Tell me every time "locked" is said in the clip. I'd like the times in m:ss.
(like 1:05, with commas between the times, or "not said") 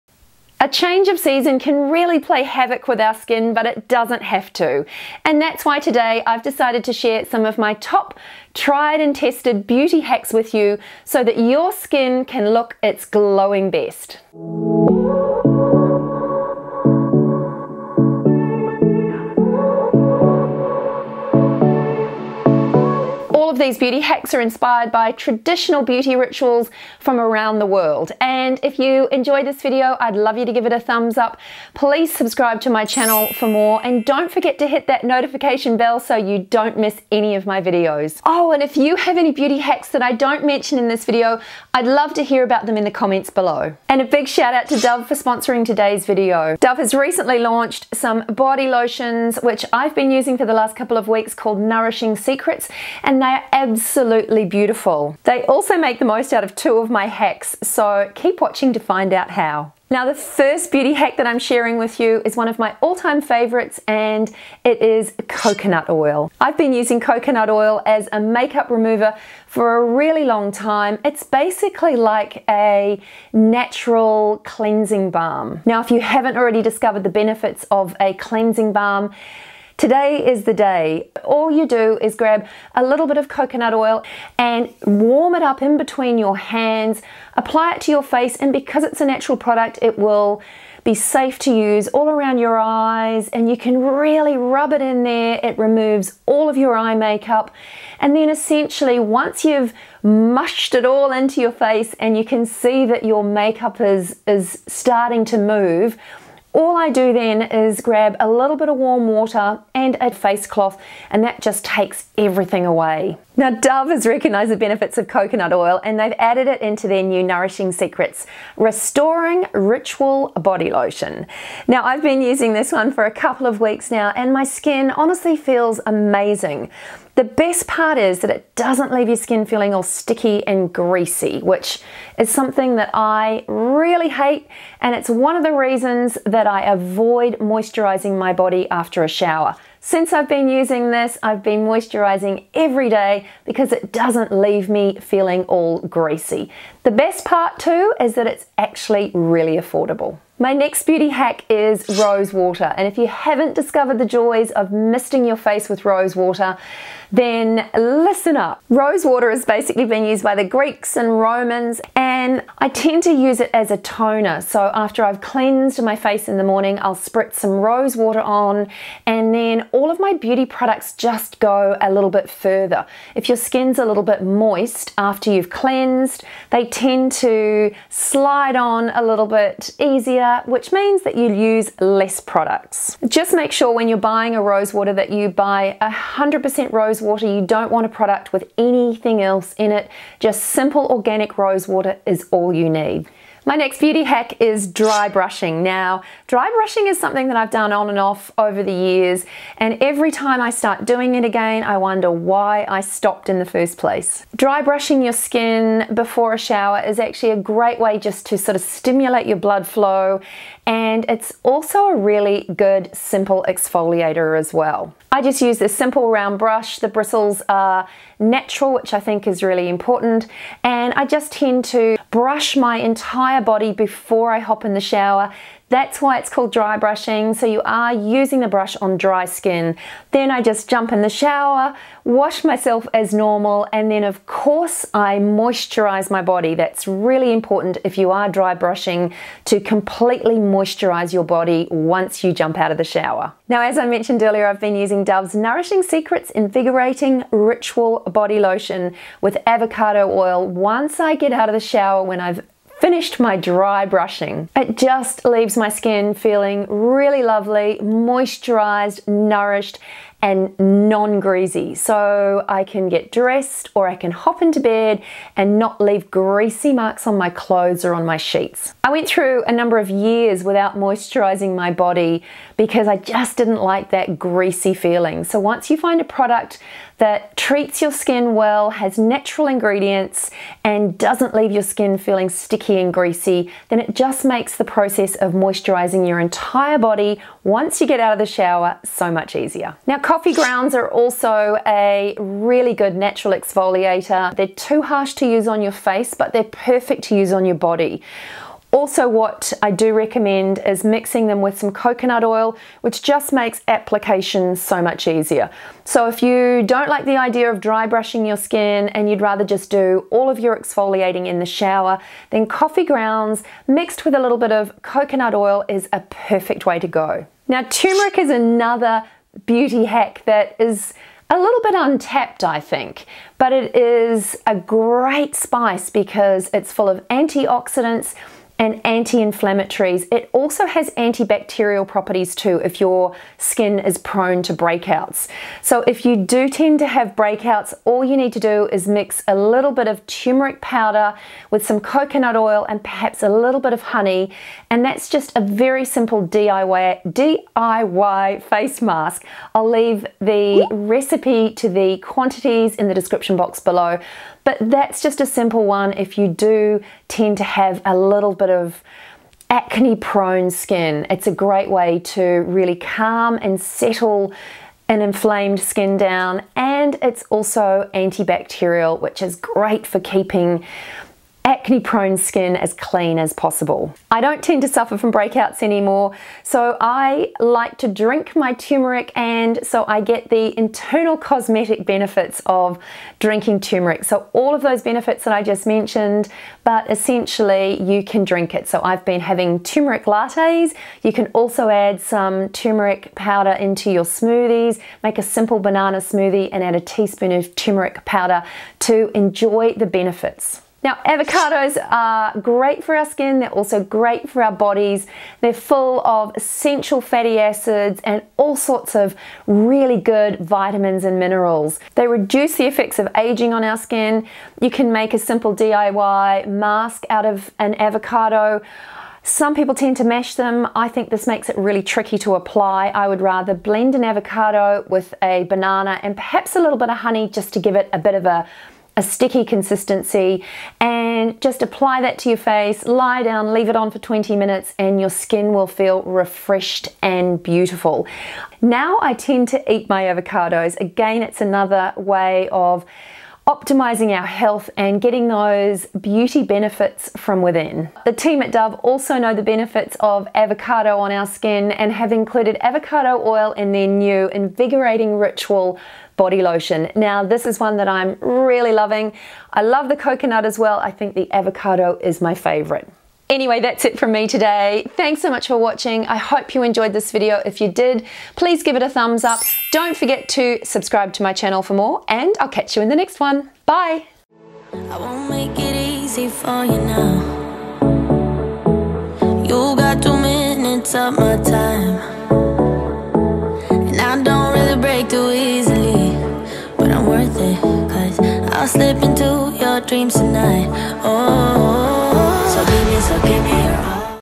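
not said.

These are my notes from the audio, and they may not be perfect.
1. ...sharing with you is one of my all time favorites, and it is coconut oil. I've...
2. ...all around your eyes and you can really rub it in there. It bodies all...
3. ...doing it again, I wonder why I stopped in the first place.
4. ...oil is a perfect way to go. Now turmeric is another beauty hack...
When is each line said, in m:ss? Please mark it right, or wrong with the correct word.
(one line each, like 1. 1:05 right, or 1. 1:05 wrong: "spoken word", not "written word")
1. 1:01 right
2. 1:31 wrong: "removes", not "bodies"
3. 3:20 right
4. 5:15 right.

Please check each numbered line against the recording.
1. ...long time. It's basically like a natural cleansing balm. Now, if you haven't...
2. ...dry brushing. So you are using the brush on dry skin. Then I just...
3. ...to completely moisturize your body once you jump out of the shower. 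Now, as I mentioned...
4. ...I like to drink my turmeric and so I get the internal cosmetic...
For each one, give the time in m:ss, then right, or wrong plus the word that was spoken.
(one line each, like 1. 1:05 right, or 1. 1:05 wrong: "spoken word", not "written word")
1. 1:10 right
2. 3:46 right
3. 3:59 right
4. 6:16 right.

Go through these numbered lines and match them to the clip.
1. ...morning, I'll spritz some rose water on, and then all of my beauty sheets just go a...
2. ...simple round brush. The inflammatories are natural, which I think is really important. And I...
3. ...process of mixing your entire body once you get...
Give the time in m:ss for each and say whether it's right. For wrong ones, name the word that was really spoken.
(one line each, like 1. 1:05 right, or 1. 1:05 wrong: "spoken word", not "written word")
1. 2:46 wrong: "products", not "sheets"
2. 3:35 wrong: "bristles", not "inflammatories"
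3. 4:44 wrong: "moisturizing", not "mixing".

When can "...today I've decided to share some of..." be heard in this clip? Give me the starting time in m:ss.
0:05.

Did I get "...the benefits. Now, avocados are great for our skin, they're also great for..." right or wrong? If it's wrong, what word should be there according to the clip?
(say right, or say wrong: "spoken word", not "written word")
right.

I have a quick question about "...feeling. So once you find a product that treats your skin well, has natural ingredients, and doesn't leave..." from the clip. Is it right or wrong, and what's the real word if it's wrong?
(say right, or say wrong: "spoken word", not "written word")
right.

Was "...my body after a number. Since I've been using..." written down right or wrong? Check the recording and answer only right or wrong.
wrong.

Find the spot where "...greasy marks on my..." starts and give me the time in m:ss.
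4:26.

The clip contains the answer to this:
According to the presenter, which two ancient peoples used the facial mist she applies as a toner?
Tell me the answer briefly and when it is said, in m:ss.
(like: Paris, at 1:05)
Greeks and Romans, at 2:40.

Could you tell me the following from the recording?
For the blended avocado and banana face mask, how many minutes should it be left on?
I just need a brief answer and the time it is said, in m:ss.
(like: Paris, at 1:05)
20, at 7:13.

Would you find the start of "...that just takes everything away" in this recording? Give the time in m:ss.
1:51.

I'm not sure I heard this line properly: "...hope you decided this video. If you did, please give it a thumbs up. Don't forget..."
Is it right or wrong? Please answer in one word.
wrong.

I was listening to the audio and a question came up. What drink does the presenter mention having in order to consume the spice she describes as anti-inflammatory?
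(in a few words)
turmeric lattes.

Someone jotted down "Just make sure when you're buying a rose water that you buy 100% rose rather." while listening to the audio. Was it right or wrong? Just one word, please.
wrong.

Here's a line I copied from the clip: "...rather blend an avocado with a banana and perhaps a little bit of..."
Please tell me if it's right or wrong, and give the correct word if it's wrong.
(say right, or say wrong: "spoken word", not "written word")
right.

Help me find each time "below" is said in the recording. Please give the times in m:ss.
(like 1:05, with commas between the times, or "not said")
0:43, 5:53.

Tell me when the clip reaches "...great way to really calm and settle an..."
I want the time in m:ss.
6:01.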